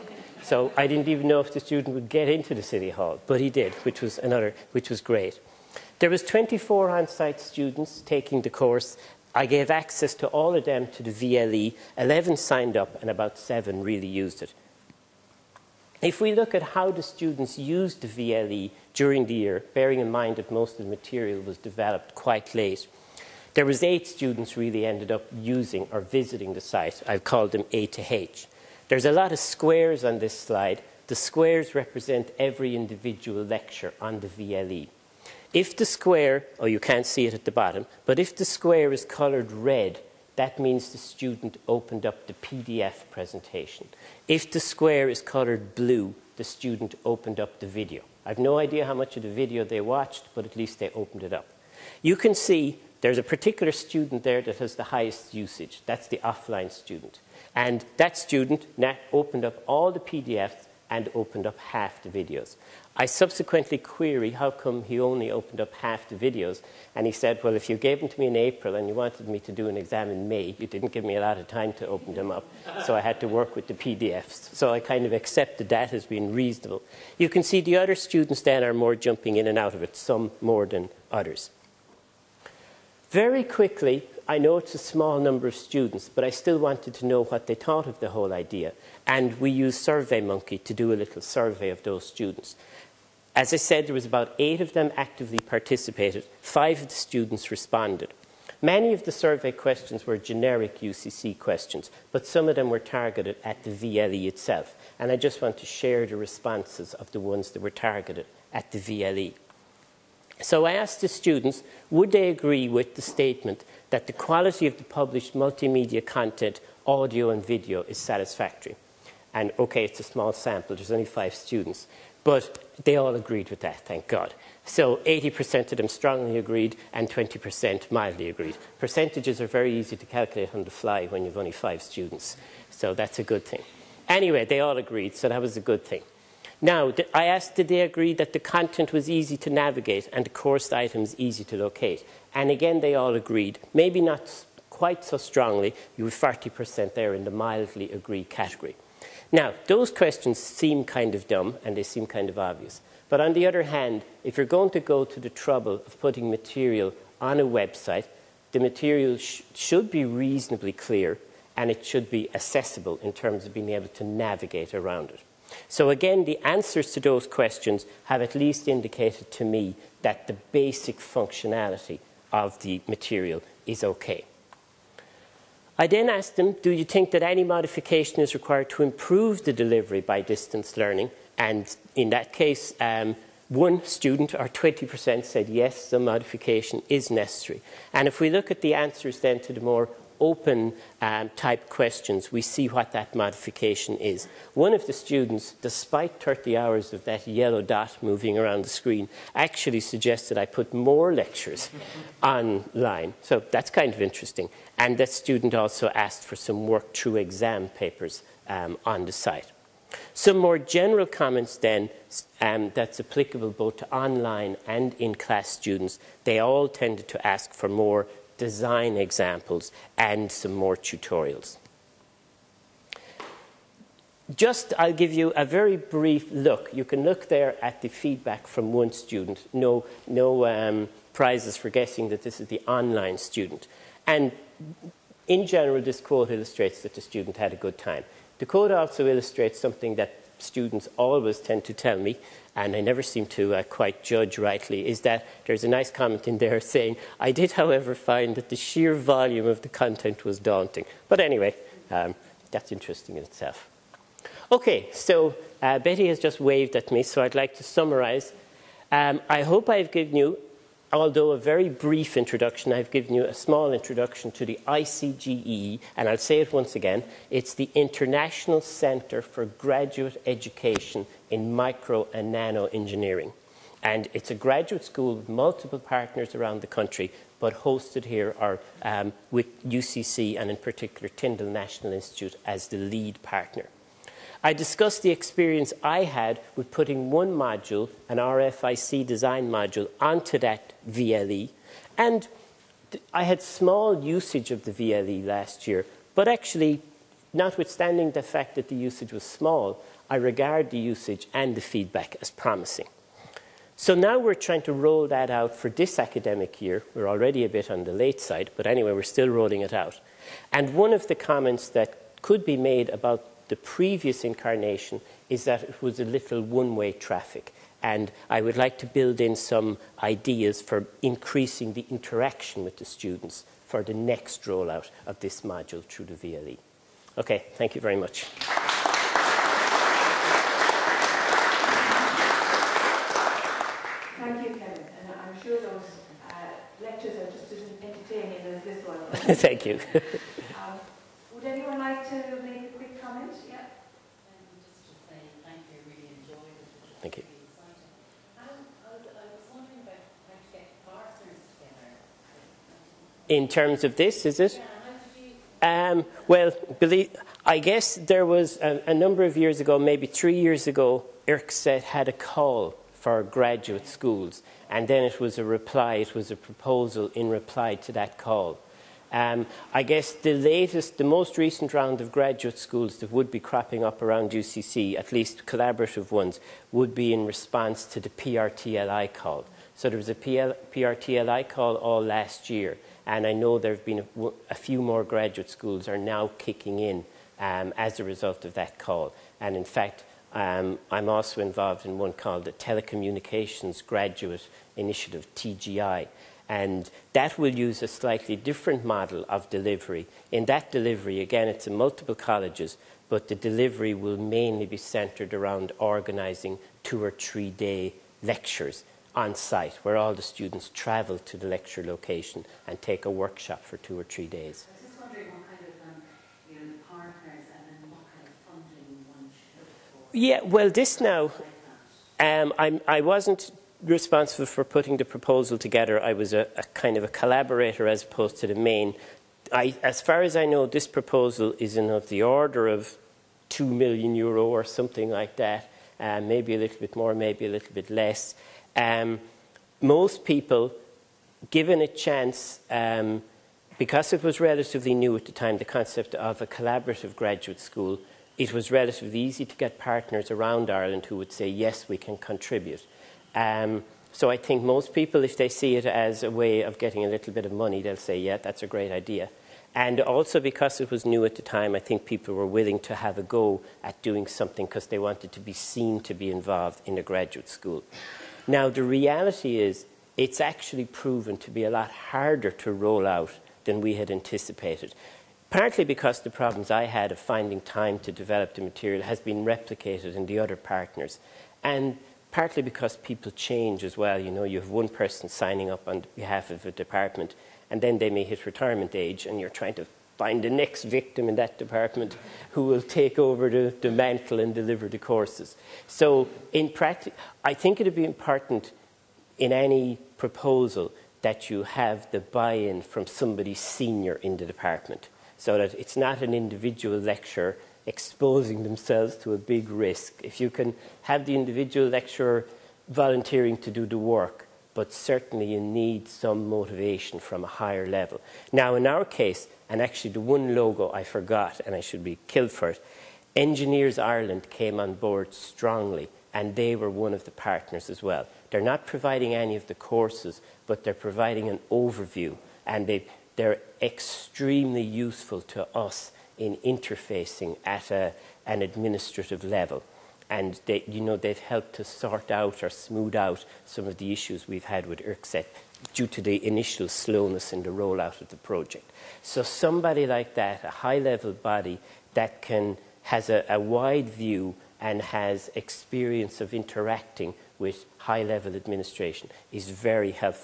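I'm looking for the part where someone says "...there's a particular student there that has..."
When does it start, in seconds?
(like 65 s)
52 s.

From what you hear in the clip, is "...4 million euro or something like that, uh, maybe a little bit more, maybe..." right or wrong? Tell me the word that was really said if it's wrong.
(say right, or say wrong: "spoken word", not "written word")
wrong: "2", not "4".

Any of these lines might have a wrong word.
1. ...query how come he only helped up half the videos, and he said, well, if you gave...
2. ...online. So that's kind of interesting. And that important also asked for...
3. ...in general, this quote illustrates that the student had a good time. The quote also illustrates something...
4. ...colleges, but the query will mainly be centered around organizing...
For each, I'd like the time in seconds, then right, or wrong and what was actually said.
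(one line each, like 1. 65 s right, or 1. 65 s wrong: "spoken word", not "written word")
1. 63 s wrong: "opened", not "helped"
2. 202 s wrong: "student", not "important"
3. 235 s right
4. 402 s wrong: "delivery", not "query".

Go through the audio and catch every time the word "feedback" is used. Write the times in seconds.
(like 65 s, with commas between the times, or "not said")
227 s, 301 s.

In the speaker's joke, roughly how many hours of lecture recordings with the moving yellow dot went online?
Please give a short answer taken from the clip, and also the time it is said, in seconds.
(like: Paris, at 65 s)
30, at 196 s.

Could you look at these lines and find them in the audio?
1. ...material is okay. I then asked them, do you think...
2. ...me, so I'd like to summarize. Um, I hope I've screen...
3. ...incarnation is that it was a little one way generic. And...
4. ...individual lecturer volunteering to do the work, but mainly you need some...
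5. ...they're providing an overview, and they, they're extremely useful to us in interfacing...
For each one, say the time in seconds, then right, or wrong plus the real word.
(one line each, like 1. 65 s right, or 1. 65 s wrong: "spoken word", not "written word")
1. 172 s right
2. 256 s wrong: "given", not "screen"
3. 314 s wrong: "traffic", not "generic"
4. 511 s wrong: "certainly", not "mainly"
5. 530 s right.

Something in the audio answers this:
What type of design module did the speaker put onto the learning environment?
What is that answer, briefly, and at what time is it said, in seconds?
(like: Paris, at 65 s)
RFIC design, at 288 s.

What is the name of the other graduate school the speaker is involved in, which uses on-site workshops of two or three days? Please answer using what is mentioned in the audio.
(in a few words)
Telecommunications Graduate Initiative.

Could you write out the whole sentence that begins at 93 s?
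As I said, there was about eight of them actively participated.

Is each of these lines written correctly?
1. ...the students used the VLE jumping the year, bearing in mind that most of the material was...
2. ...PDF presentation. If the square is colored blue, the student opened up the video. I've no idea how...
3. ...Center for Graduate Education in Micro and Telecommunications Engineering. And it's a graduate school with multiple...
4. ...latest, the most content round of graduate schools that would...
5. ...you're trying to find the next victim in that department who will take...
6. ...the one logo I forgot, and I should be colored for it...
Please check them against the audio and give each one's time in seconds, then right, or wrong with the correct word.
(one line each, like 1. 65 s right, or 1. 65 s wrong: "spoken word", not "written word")
1. 16 s wrong: "during", not "jumping"
2. 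42 s right
3. 268 s wrong: "Nano", not "Telecommunications"
4. 370 s wrong: "recent", not "content"
5. 489 s right
6. 520 s wrong: "killed", not "colored".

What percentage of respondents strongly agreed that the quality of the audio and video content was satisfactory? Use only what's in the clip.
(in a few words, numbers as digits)
80%.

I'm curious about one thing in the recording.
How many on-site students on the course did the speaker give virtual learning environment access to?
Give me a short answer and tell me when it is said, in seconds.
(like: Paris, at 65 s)
24, at 6 s.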